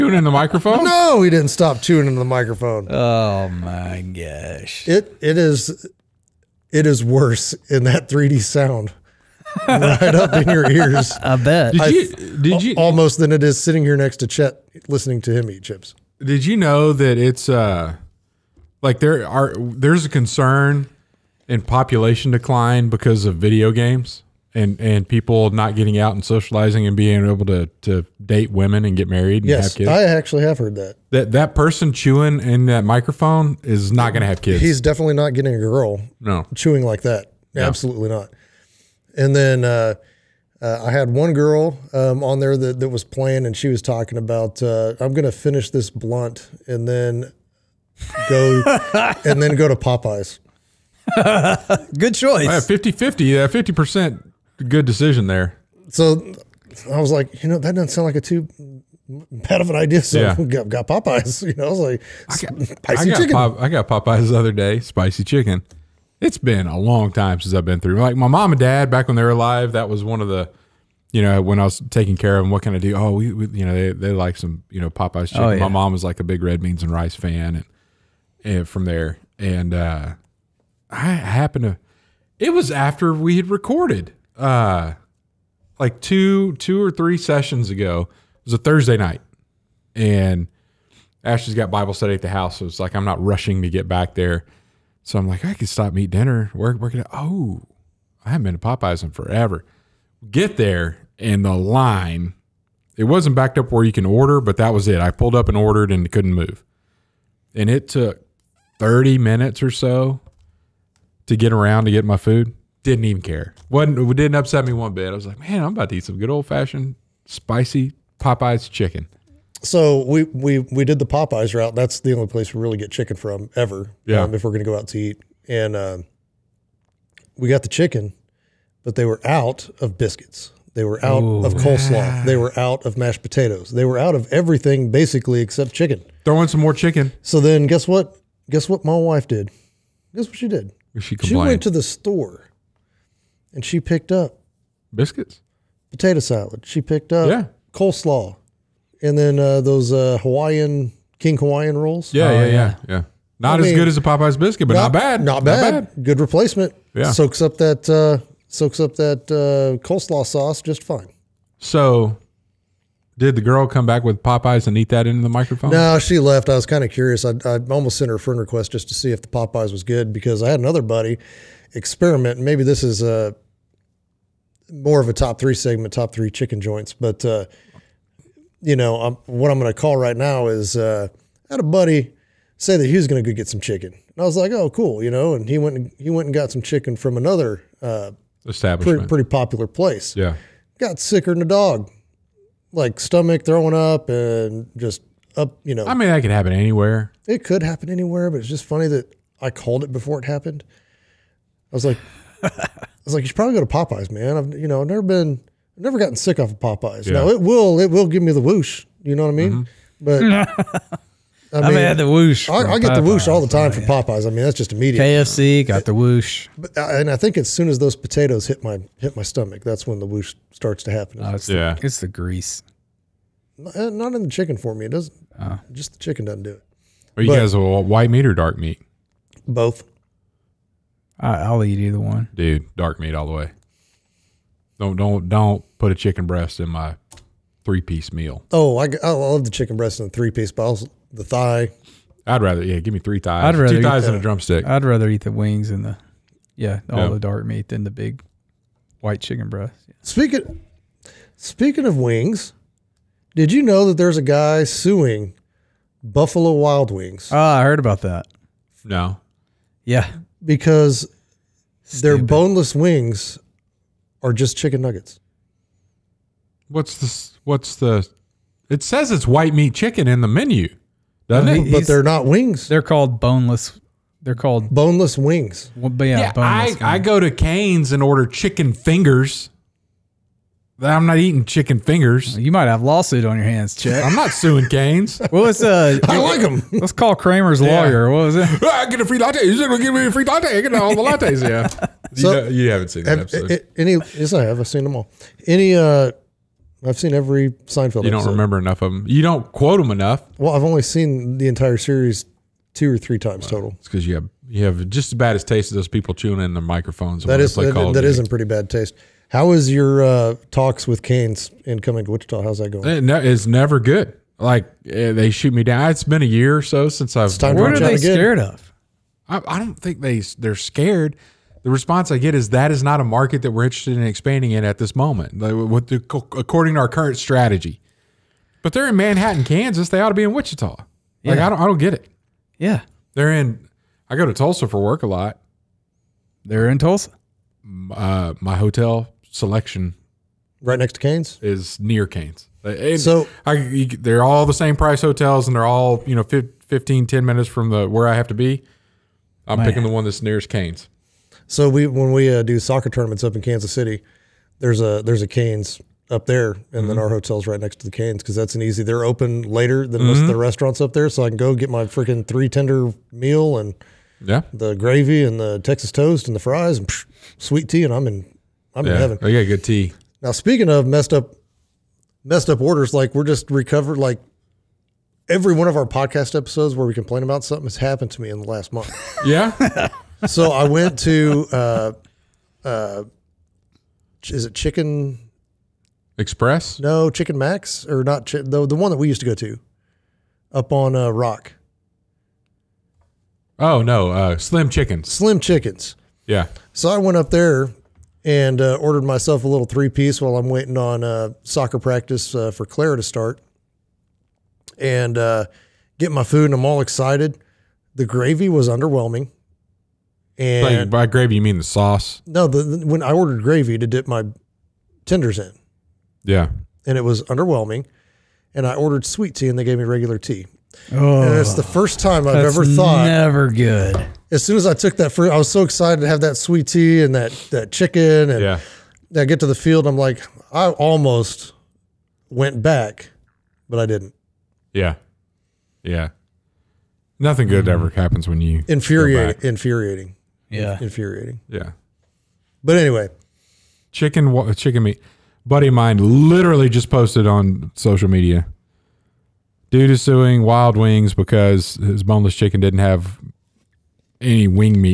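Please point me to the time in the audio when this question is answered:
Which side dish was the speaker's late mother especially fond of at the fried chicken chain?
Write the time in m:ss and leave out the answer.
1:16.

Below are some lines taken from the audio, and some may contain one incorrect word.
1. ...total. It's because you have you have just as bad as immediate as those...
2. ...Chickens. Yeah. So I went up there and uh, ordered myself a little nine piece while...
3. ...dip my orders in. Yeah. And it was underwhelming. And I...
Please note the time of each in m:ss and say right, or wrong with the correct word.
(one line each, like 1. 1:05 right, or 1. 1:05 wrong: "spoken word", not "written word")
1. 5:03 wrong: "taste", not "immediate"
2. 6:35 wrong: "three", not "nine"
3. 6:53 wrong: "tenders", not "orders".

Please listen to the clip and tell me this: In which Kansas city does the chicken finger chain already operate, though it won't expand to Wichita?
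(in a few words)
Manhattan, Kansas.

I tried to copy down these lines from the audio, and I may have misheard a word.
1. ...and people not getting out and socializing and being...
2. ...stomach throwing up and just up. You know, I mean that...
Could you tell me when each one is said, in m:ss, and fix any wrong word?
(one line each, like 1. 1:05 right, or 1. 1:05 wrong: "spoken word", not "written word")
1. 0:24 right
2. 3:12 right.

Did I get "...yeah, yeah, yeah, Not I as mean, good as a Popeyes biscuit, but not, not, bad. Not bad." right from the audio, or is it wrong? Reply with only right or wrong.
right.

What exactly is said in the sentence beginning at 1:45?
I pulled up and ordered and couldn't move.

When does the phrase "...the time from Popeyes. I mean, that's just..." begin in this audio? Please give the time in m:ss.
3:33.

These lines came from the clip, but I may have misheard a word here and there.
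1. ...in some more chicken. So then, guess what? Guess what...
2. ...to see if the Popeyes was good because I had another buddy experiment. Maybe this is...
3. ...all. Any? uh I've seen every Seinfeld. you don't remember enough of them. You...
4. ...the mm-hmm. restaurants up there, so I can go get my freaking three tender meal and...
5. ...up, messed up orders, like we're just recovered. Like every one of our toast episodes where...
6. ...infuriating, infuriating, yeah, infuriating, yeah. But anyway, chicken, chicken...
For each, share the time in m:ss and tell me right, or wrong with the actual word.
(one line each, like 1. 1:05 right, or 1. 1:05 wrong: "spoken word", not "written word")
1. 2:16 right
2. 2:48 right
3. 4:54 right
4. 6:00 right
5. 6:11 wrong: "podcast", not "toast"
6. 7:18 right.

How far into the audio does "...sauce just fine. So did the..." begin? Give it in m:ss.
2:40.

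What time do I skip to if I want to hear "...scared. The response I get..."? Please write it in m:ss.
5:20.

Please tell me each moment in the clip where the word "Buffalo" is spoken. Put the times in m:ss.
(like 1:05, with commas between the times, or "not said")
4:16.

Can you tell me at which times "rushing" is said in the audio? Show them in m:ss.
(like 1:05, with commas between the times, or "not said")
1:33.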